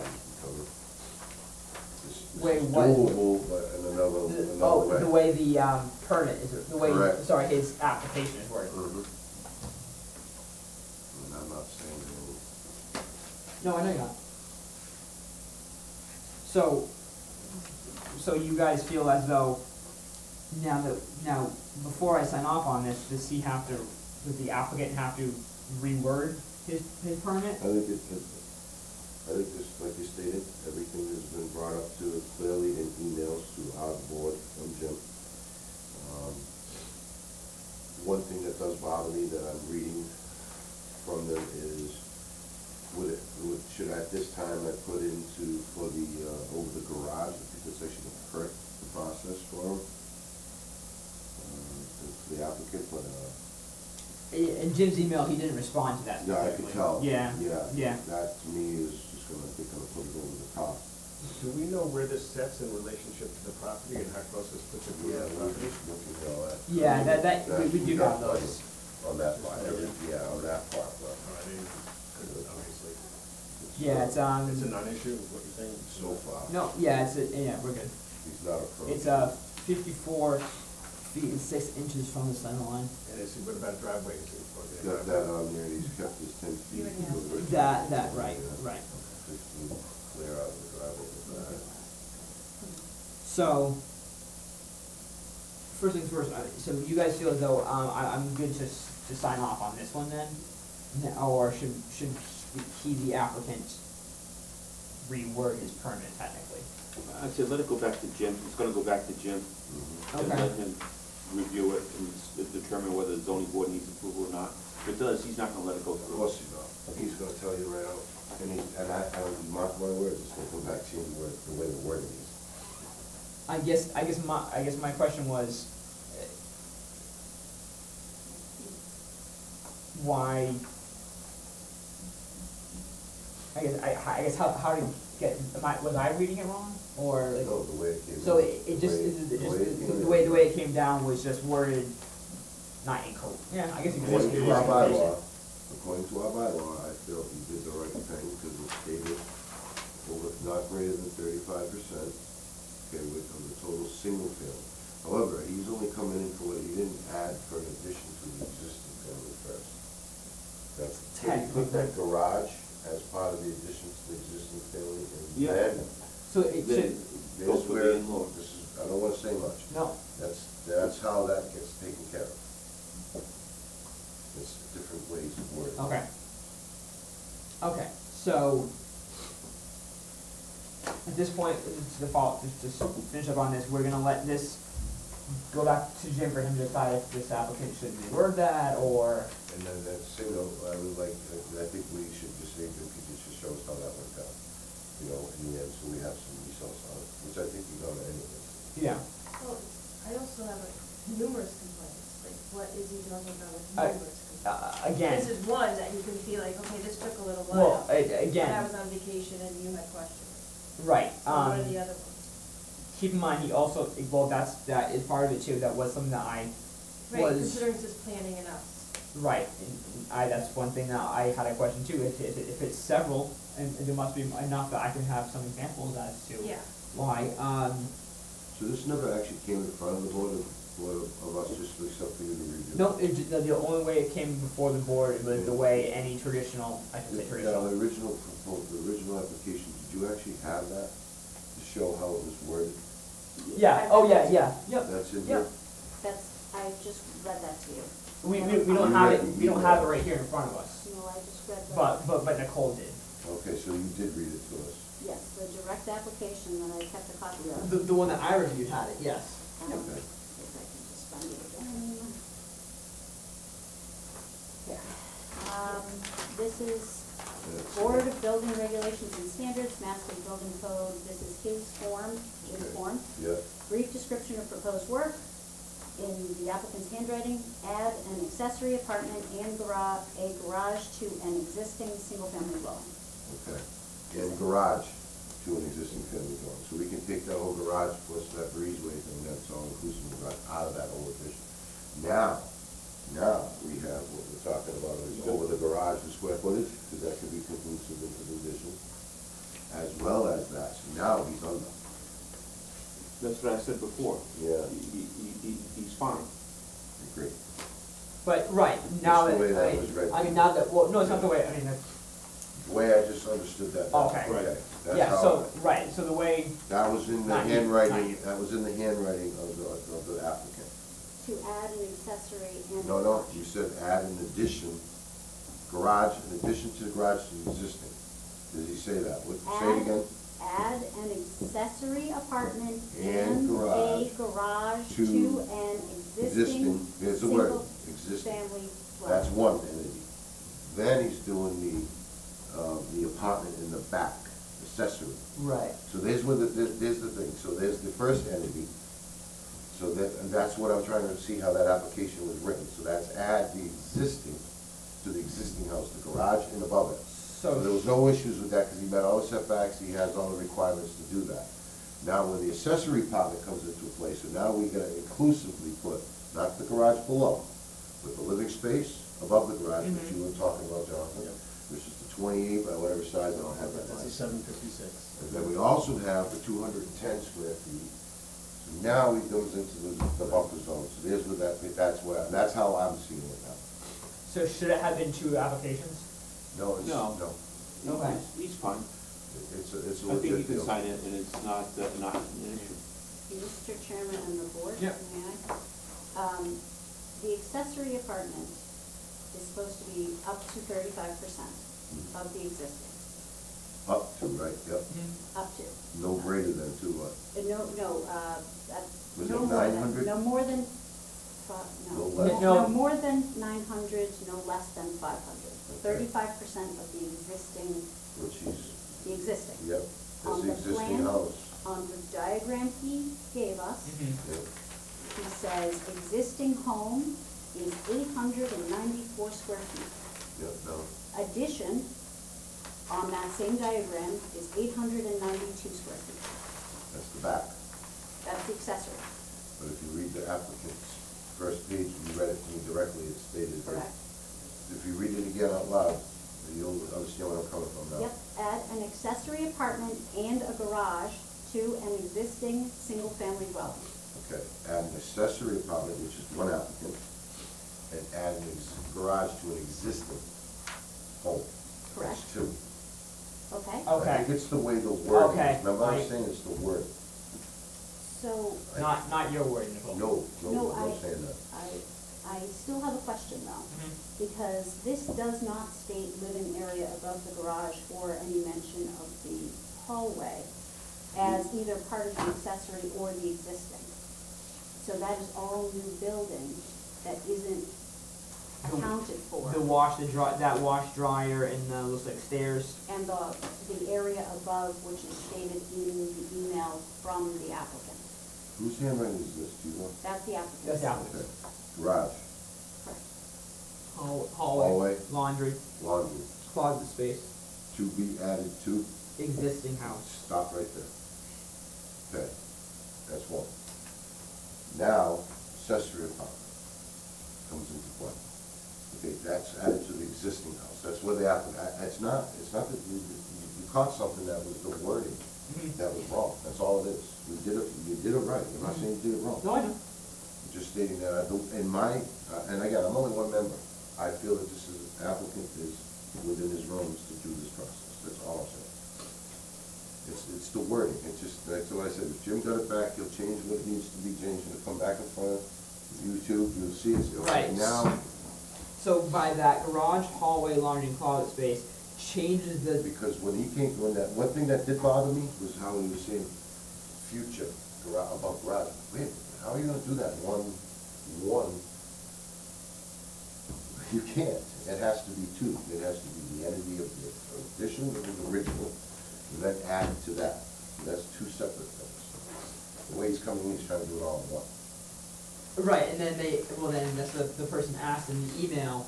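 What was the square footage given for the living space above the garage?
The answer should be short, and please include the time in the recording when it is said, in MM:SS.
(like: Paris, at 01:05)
756, at 06:14.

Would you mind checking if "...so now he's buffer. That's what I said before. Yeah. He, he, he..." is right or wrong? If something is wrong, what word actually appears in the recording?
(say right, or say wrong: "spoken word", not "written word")
wrong: "under", not "buffer".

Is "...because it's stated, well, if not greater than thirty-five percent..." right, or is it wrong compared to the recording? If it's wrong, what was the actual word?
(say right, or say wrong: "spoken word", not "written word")
right.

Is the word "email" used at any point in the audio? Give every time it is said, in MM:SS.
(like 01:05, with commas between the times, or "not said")
00:32, 00:55, 08:16.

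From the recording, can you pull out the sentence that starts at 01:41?
Or should, should he, the applicant, reword his permit technically?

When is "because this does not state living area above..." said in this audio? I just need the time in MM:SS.
07:54.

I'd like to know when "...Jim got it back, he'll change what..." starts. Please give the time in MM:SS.
09:02.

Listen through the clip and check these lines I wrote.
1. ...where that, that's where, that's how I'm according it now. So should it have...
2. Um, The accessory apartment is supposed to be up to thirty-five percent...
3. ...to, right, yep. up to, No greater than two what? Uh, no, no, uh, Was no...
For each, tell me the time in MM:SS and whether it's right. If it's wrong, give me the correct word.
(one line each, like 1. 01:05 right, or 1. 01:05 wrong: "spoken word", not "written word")
1. 06:21 wrong: "seeing", not "according"
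2. 06:36 right
3. 06:44 right.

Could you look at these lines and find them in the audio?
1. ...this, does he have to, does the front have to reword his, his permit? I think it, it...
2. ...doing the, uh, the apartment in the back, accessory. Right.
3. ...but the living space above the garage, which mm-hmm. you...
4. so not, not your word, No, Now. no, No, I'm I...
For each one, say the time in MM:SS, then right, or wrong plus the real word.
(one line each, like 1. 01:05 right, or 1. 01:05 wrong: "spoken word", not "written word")
1. 00:22 wrong: "applicant", not "front"
2. 05:41 right
3. 06:08 right
4. 07:48 wrong: "Nicole", not "Now".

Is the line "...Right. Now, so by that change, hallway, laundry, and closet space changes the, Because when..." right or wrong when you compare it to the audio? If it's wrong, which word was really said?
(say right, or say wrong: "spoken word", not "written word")
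wrong: "garage", not "change".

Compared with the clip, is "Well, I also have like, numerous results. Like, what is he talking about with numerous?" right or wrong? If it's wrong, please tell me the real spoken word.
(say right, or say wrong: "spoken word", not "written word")
wrong: "complaints", not "results".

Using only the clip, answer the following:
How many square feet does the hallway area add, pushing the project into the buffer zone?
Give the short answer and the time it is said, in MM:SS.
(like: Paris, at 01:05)
210, at 06:16.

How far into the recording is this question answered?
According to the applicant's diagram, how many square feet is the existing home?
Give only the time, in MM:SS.
07:07.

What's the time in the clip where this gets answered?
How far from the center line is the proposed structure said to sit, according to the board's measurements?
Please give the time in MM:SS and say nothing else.
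01:19.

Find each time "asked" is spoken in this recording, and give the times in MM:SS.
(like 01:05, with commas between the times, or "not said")
09:37.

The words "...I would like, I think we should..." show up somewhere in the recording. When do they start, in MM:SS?
03:10.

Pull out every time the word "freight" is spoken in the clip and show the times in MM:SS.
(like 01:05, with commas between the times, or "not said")
not said.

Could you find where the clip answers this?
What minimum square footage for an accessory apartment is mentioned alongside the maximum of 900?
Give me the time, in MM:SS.
06:55.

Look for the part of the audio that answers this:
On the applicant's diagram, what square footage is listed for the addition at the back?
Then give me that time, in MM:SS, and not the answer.
07:14.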